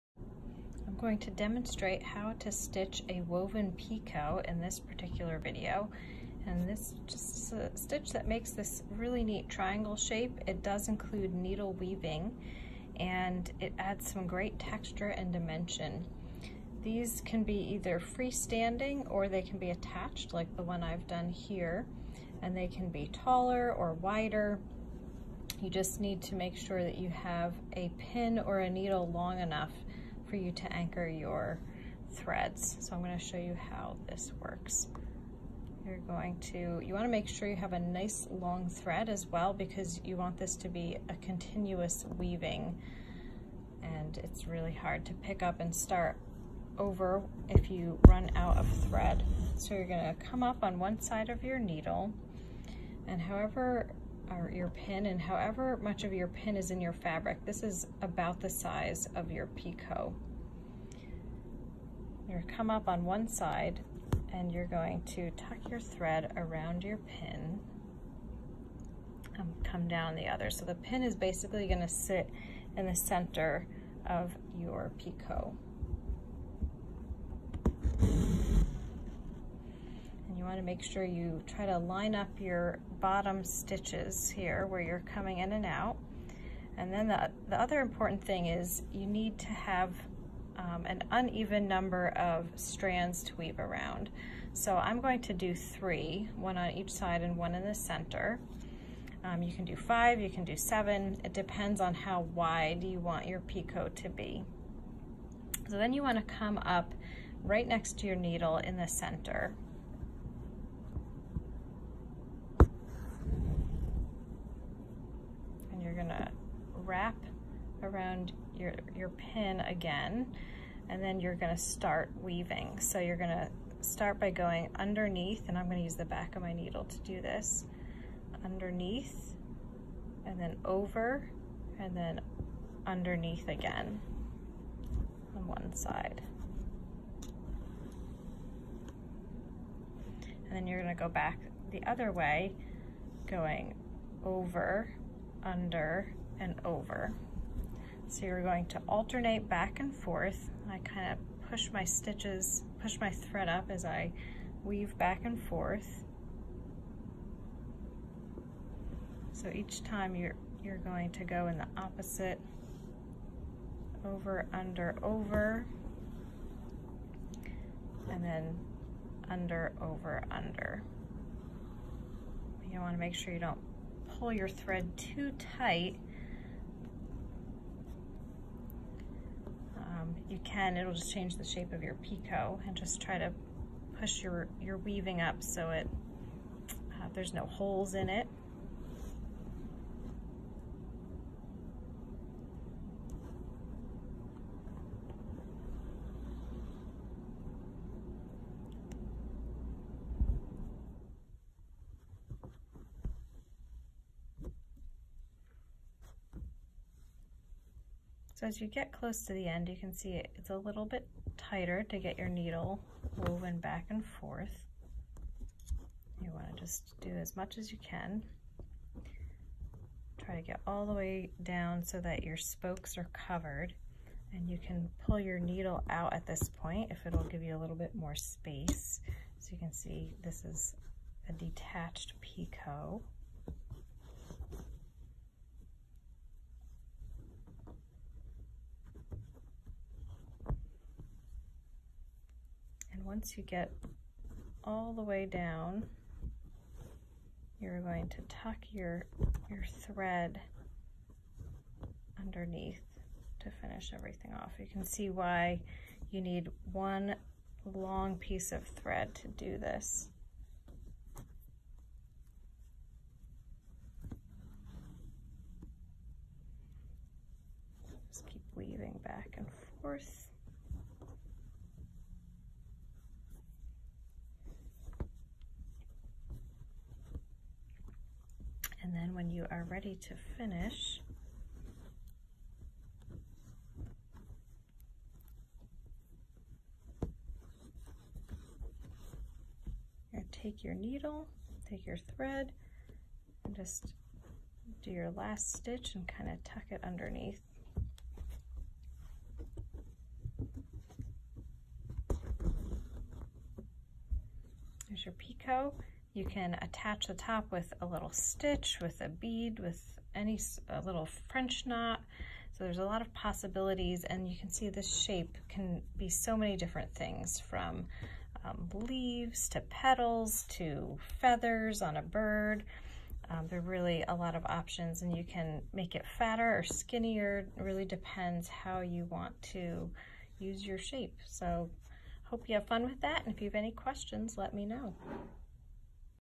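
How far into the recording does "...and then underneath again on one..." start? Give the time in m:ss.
2:11.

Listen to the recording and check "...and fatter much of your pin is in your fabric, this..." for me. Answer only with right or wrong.
wrong.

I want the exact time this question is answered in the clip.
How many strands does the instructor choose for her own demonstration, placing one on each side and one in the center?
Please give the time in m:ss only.
1:35.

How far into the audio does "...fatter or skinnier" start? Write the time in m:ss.
5:26.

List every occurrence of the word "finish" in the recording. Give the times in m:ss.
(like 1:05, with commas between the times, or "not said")
4:13, 4:40.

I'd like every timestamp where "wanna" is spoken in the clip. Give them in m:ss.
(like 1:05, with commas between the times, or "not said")
0:36, 1:20.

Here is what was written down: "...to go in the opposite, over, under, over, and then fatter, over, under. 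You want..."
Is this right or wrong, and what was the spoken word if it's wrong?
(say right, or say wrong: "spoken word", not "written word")
wrong: "under", not "fatter".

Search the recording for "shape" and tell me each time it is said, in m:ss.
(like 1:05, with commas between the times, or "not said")
0:09, 3:01, 5:15, 5:30.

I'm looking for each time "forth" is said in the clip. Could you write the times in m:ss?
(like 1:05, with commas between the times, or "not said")
2:29, 2:35, 3:34, 4:29.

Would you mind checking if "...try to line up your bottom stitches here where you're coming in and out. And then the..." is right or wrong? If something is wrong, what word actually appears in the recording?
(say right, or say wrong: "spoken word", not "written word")
right.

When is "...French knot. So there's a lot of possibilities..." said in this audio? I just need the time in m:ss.
5:11.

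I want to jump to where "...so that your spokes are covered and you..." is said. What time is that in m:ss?
3:41.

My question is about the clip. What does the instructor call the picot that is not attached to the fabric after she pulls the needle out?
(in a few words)
detached picot.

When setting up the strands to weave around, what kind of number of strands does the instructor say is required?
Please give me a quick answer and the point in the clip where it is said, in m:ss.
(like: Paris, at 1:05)
uneven number, at 1:31.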